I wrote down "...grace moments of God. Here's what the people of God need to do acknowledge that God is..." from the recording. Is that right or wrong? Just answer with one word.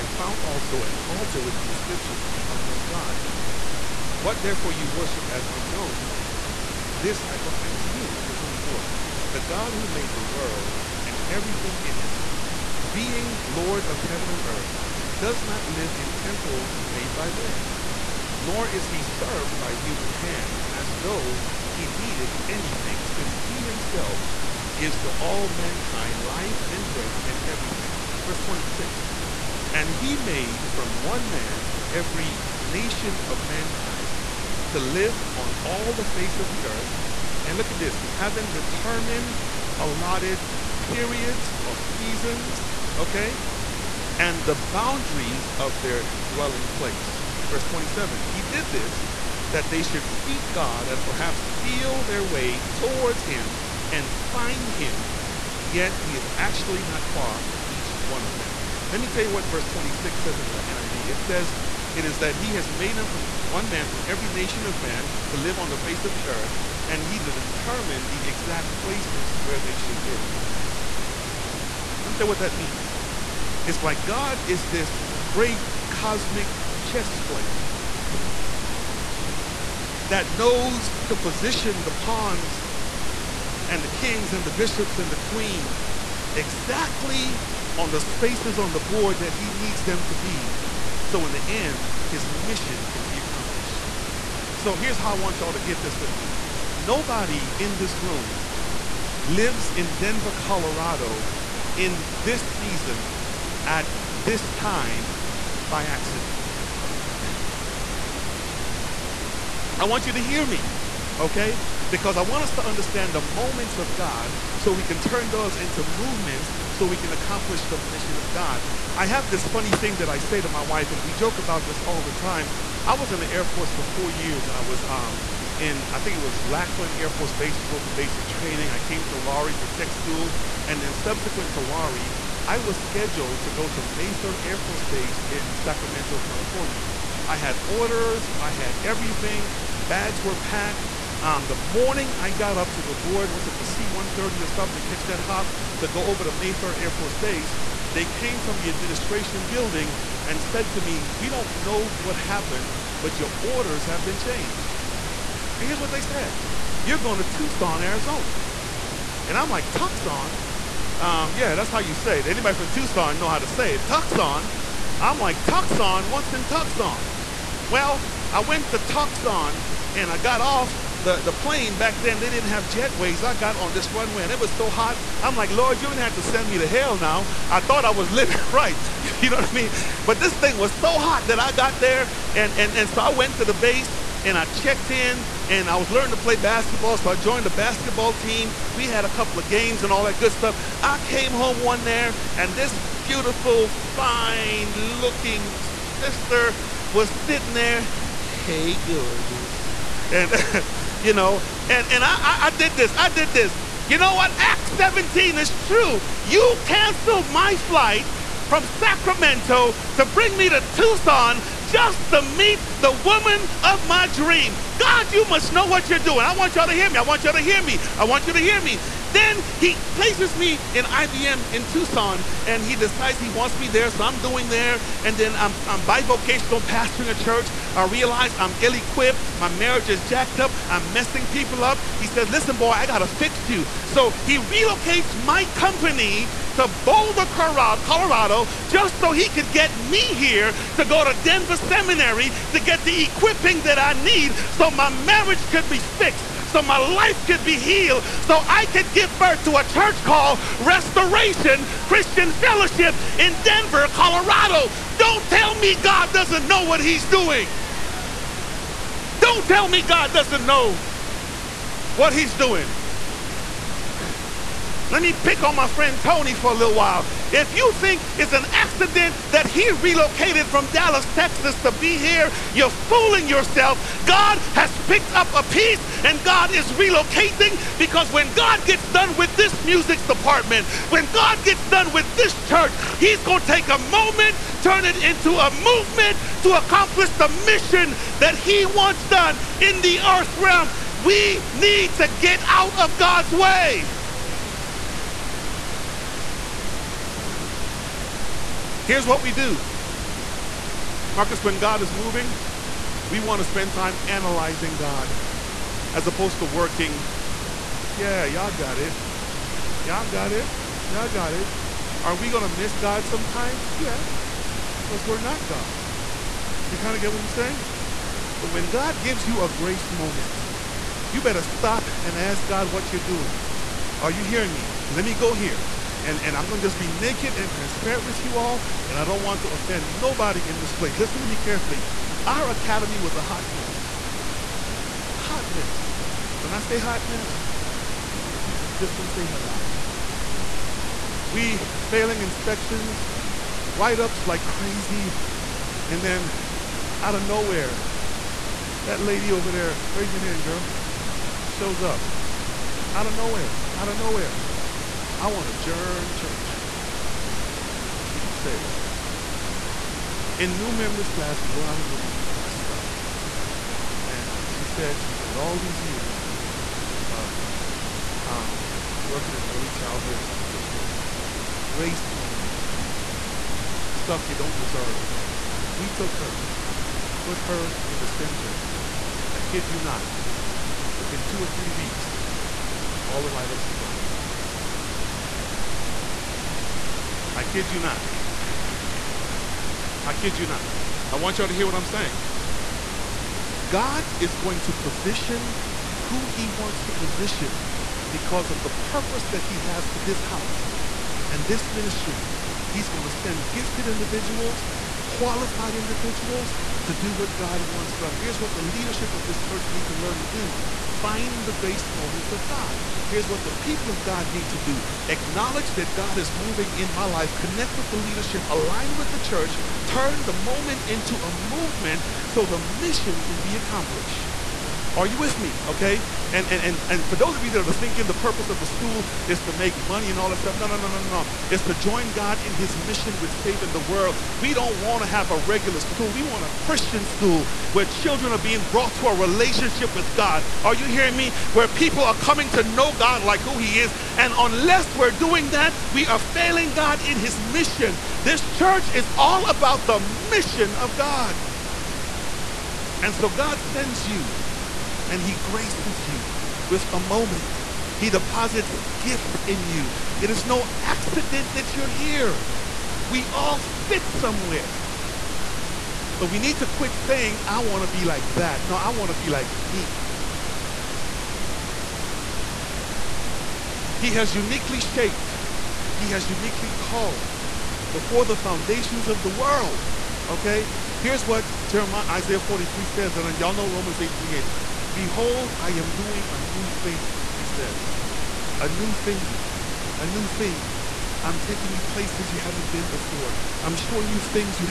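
right.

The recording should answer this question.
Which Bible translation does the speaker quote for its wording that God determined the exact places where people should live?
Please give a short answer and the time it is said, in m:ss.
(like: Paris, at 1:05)
NIV, at 1:00.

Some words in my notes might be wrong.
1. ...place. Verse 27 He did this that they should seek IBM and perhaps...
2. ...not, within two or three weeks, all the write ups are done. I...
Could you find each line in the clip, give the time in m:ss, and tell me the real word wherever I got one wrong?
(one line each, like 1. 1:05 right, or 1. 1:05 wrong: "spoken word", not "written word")
1. 0:46 wrong: "God", not "IBM"
2. 6:19 right.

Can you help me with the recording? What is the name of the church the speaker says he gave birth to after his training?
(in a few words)
Restoration Christian Fellowship.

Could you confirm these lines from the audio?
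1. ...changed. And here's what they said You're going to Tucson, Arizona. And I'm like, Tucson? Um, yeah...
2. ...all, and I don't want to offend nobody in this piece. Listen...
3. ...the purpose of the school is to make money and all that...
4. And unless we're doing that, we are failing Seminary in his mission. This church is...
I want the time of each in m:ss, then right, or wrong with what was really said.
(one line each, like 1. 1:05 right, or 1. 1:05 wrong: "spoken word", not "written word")
1. 2:34 right
2. 5:28 wrong: "place", not "piece"
3. 7:08 right
4. 7:24 wrong: "God", not "Seminary".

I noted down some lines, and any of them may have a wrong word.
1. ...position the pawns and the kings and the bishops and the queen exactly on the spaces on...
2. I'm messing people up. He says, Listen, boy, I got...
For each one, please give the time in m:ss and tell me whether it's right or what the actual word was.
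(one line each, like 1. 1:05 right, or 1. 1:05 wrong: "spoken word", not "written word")
1. 1:21 right
2. 3:50 right.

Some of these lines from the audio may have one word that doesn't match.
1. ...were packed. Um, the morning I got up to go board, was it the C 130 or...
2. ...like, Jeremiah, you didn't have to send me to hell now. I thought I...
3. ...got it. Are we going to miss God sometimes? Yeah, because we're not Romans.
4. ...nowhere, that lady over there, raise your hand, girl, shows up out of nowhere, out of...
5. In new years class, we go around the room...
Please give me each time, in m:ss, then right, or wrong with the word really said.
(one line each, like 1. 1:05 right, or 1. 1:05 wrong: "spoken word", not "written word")
1. 2:20 right
2. 2:55 wrong: "Lord", not "Jeremiah"
3. 5:11 wrong: "God", not "Romans"
4. 5:47 right
5. 6:00 wrong: "members", not "years".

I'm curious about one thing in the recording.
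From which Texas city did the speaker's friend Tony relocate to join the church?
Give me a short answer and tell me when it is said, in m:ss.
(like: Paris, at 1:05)
Dallas, at 4:30.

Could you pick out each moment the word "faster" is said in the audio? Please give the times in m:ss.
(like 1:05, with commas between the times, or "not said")
not said.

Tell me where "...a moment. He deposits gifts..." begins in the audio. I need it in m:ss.
7:36.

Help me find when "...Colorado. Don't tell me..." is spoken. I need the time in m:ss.
4:13.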